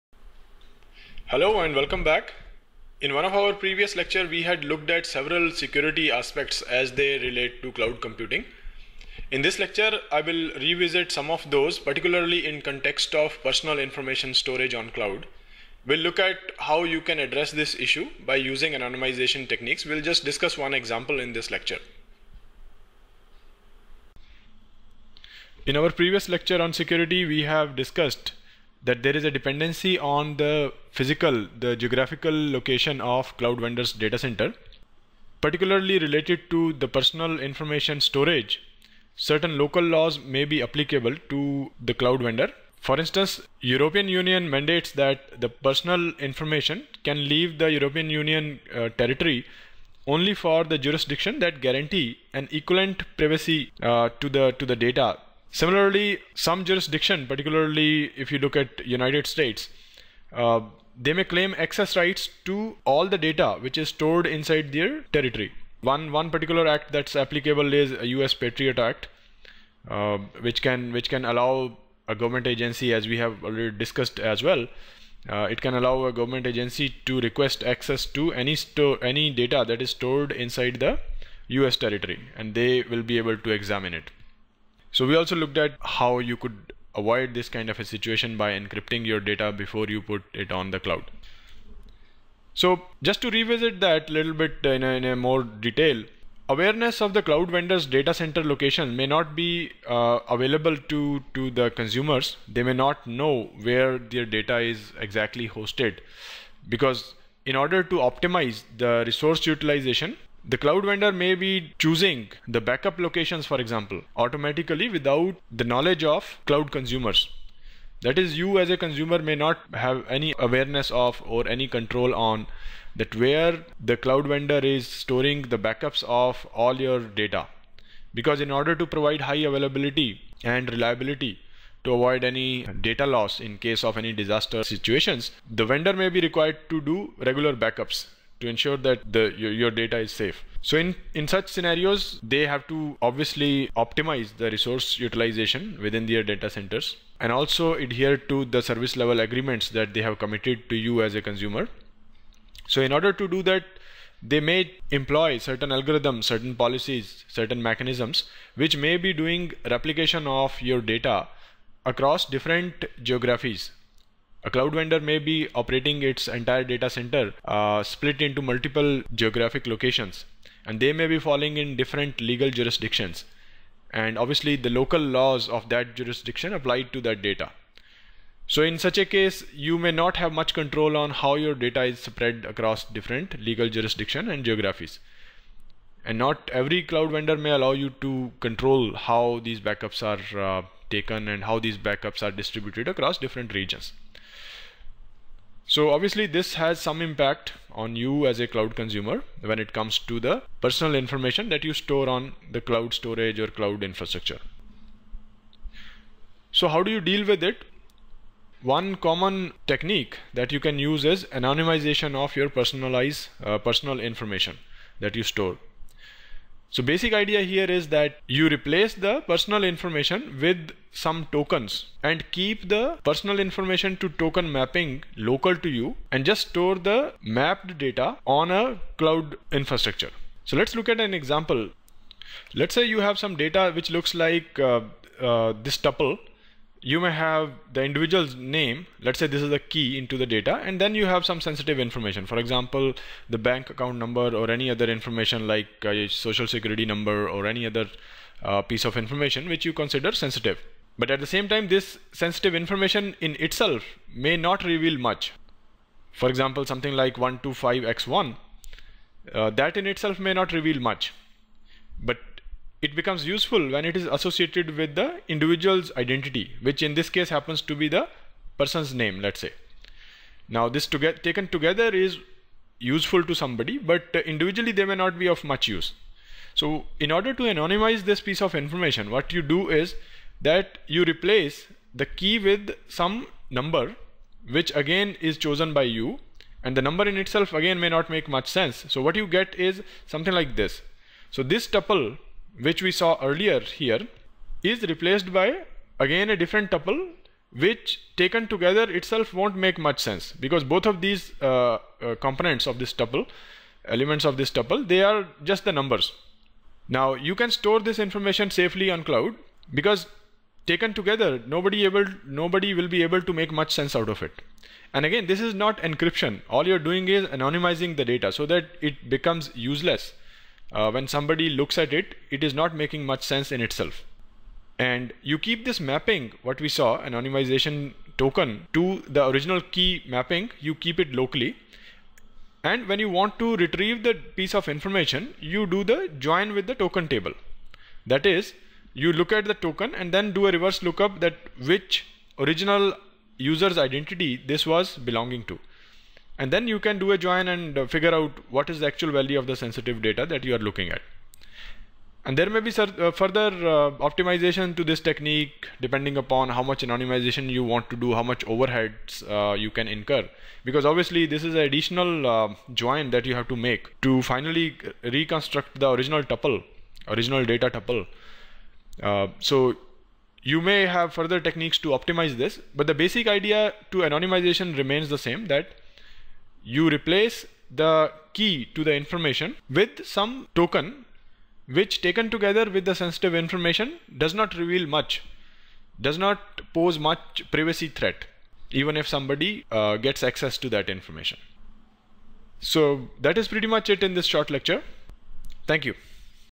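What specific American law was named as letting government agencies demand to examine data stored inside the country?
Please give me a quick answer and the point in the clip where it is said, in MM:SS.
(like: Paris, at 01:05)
U.S. Patriot Act, at 01:08.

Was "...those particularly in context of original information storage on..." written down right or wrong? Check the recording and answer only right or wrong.
wrong.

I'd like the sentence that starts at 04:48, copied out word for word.
So what you get is something like this.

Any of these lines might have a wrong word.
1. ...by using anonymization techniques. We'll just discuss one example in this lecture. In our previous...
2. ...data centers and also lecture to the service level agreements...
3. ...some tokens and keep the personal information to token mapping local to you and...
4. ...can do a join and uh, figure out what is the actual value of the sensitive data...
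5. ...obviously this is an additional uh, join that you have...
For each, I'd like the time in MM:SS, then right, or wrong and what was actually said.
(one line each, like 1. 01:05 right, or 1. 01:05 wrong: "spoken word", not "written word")
1. 00:18 right
2. 02:26 wrong: "adhere", not "lecture"
3. 03:40 right
4. 05:46 right
5. 06:00 right.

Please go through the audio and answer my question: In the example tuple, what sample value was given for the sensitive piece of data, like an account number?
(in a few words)
125x1.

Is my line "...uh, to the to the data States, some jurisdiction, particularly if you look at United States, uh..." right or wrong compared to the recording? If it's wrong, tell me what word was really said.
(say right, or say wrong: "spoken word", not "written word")
wrong: "Similarly", not "States".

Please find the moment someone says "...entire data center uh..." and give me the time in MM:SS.
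02:46.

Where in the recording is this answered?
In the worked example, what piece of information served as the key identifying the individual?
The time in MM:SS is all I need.
04:27.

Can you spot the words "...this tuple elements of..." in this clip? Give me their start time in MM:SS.
05:02.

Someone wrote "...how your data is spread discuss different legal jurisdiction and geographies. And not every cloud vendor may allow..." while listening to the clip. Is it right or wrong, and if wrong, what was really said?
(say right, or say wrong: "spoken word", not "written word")
wrong: "across", not "discuss".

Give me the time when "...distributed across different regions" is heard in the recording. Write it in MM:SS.
03:12.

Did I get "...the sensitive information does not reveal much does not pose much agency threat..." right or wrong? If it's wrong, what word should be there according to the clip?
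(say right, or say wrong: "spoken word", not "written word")
wrong: "privacy", not "agency".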